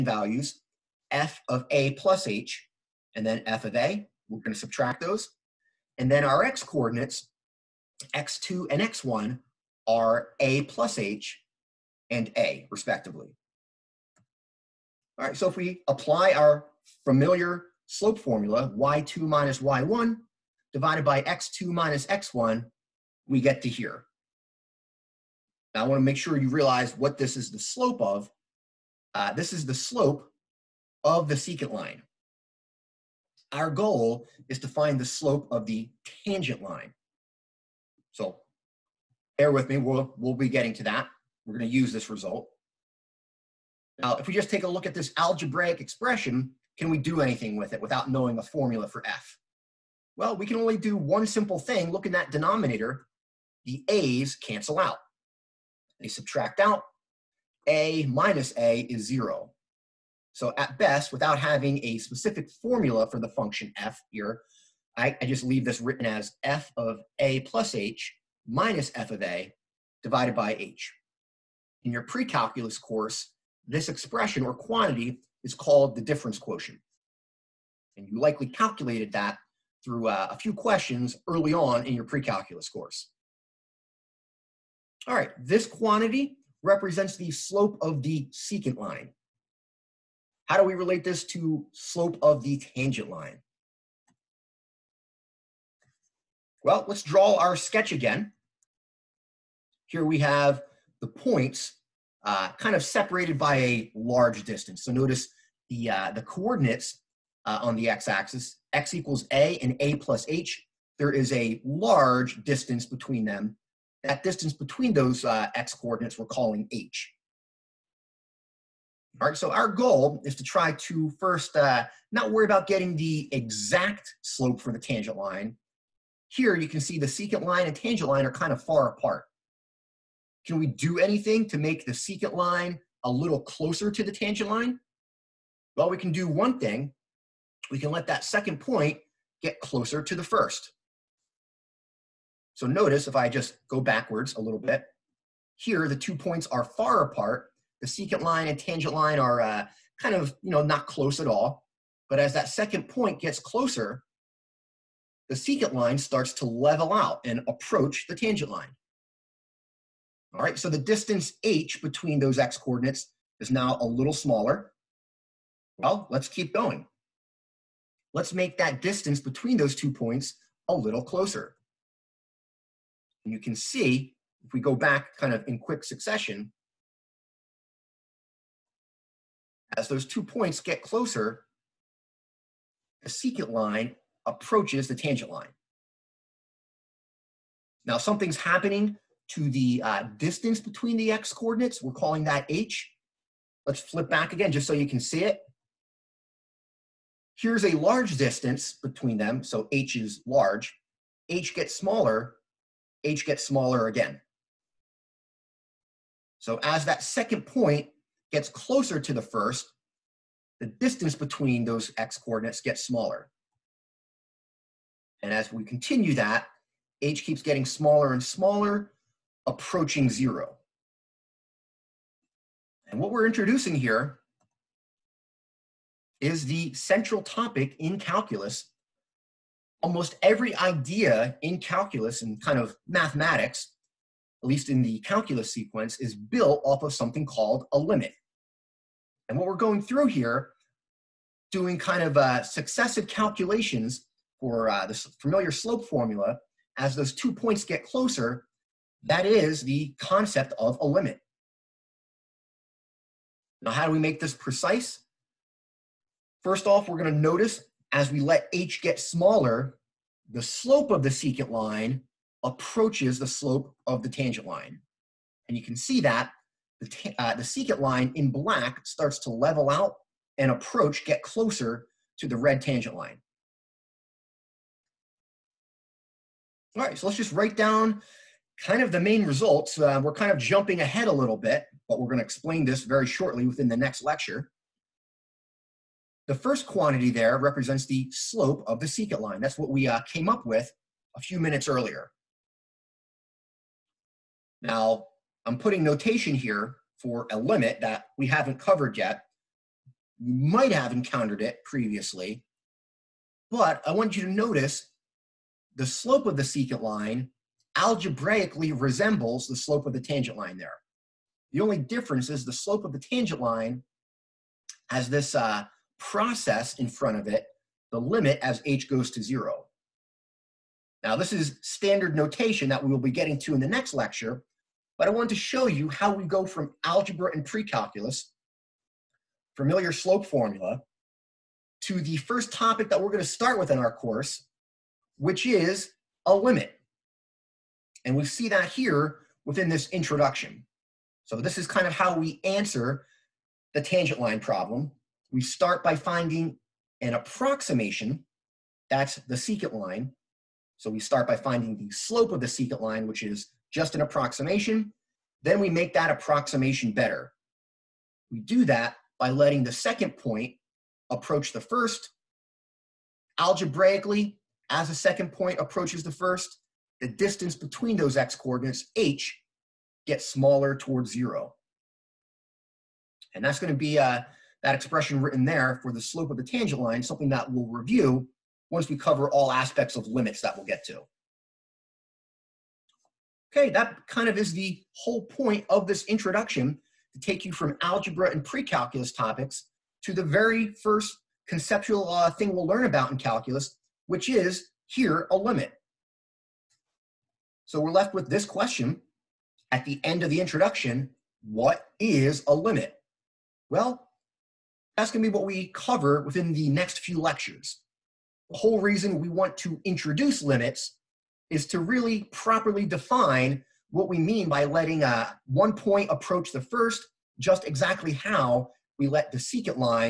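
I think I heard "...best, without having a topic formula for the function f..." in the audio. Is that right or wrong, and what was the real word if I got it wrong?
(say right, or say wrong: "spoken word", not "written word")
wrong: "specific", not "topic".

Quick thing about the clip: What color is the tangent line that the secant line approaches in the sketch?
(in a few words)
red.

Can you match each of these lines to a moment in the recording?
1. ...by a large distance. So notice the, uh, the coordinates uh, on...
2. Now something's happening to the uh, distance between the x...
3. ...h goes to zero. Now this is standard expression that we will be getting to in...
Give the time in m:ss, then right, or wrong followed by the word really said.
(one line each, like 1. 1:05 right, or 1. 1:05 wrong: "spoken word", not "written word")
1. 1:43 right
2. 3:07 right
3. 5:18 wrong: "notation", not "expression".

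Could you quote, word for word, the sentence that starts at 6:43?
Well, that's gonna be what we cover within the next few lectures.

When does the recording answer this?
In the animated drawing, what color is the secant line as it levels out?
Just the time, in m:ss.
4:28.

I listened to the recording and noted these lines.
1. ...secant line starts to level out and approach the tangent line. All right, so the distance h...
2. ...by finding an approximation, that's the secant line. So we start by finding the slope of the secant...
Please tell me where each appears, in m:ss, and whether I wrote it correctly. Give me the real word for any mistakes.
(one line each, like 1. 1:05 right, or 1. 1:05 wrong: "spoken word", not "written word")
1. 2:35 right
2. 5:45 right.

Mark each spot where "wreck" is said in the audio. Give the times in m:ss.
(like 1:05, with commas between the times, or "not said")
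not said.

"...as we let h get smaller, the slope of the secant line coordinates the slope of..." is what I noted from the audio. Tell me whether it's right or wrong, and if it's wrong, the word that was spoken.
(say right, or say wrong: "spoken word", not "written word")
wrong: "approaches", not "coordinates".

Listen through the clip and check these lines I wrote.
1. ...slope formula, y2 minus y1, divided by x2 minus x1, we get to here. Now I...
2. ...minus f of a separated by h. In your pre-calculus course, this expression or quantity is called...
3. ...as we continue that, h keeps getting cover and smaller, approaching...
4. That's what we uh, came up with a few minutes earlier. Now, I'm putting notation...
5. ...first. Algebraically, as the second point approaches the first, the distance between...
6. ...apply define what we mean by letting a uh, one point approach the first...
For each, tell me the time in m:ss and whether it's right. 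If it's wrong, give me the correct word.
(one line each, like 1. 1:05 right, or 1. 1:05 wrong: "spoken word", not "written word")
1. 0:17 right
2. 1:08 wrong: "divided", not "separated"
3. 3:35 wrong: "smaller", not "cover"
4. 4:49 right
5. 6:01 right
6. 6:52 wrong: "properly", not "apply".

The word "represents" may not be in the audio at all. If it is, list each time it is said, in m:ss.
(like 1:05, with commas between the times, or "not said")
1:26, 4:47.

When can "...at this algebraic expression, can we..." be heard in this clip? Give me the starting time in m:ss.
0:44.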